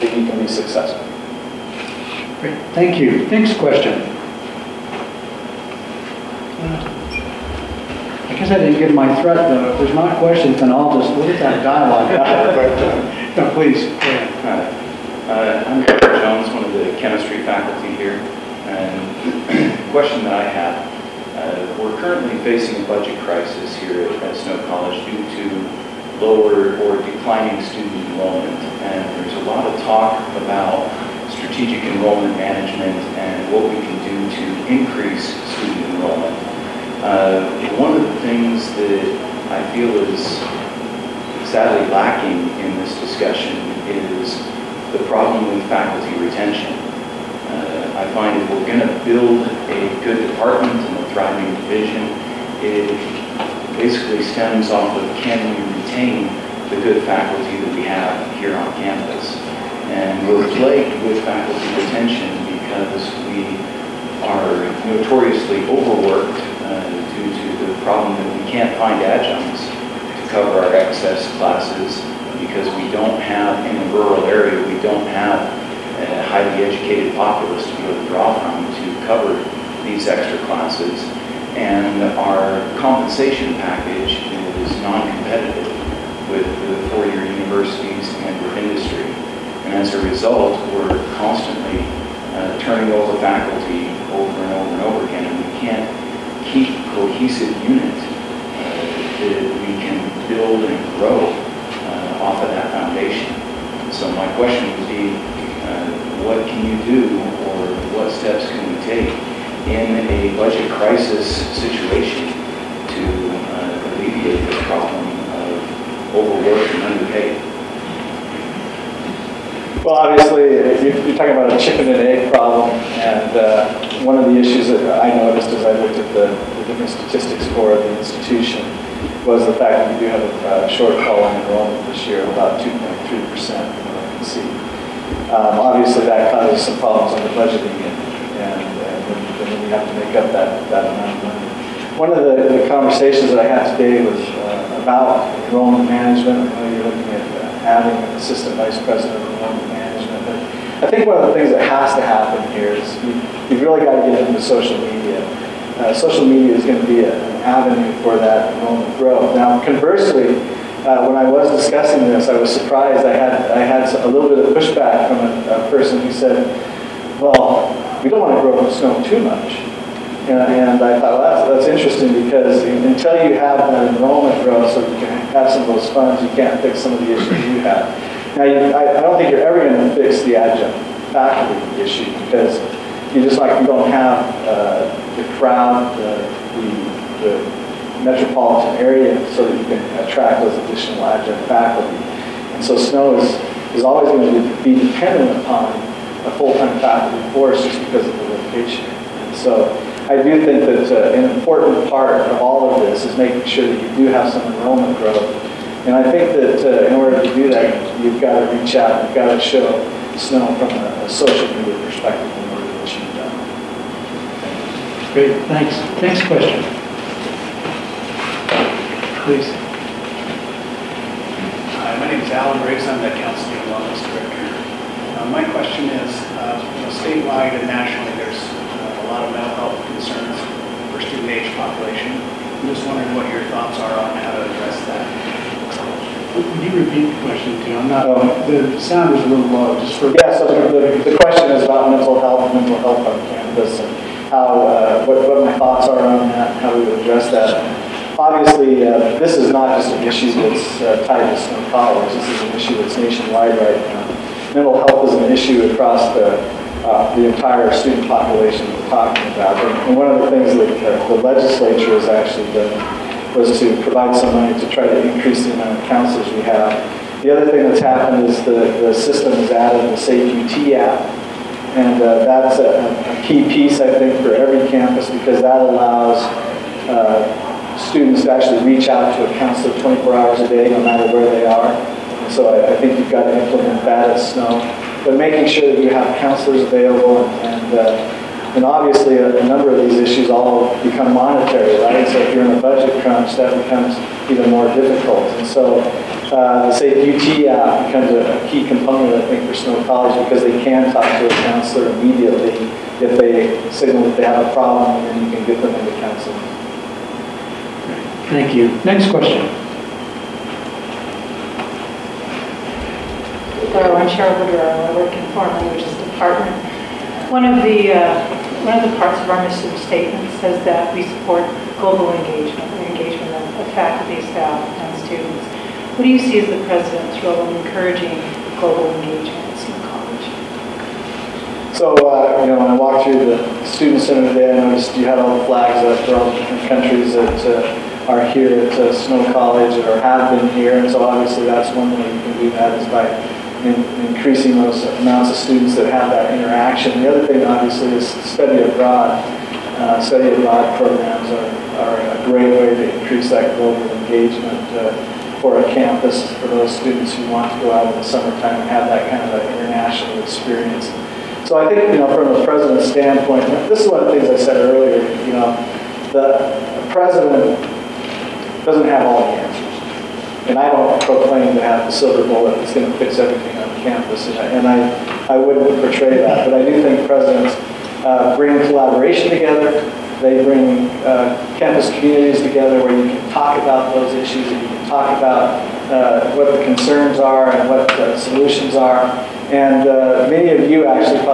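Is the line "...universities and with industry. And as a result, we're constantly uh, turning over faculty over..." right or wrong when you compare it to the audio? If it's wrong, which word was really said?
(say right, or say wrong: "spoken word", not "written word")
right.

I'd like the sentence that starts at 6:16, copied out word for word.
But I do think presidents uh, bring collaboration together.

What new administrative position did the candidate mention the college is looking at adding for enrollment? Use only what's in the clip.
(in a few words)
Assistant vice president of enrollment management.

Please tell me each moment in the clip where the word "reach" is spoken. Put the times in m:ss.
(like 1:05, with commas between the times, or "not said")
3:28, 4:38.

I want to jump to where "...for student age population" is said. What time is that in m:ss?
3:50.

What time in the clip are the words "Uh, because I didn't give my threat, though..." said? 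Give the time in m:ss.
0:06.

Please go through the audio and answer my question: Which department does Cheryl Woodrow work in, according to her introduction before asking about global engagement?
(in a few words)
Foreign languages.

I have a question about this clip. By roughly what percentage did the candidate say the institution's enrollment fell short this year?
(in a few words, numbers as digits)
2.3%.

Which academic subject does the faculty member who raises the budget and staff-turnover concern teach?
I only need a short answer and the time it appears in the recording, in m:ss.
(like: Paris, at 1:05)
Chemistry, at 0:17.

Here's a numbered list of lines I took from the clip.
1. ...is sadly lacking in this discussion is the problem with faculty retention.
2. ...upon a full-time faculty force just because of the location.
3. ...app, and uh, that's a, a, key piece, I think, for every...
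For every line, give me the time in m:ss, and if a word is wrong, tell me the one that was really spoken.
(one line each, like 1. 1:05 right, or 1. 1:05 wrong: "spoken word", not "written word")
1. 0:40 right
2. 3:15 right
3. 4:30 right.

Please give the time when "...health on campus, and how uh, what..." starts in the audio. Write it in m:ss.
4:02.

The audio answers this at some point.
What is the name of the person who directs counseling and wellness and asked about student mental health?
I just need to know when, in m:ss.
3:42.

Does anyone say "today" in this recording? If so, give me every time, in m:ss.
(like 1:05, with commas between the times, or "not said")
2:23, 5:34.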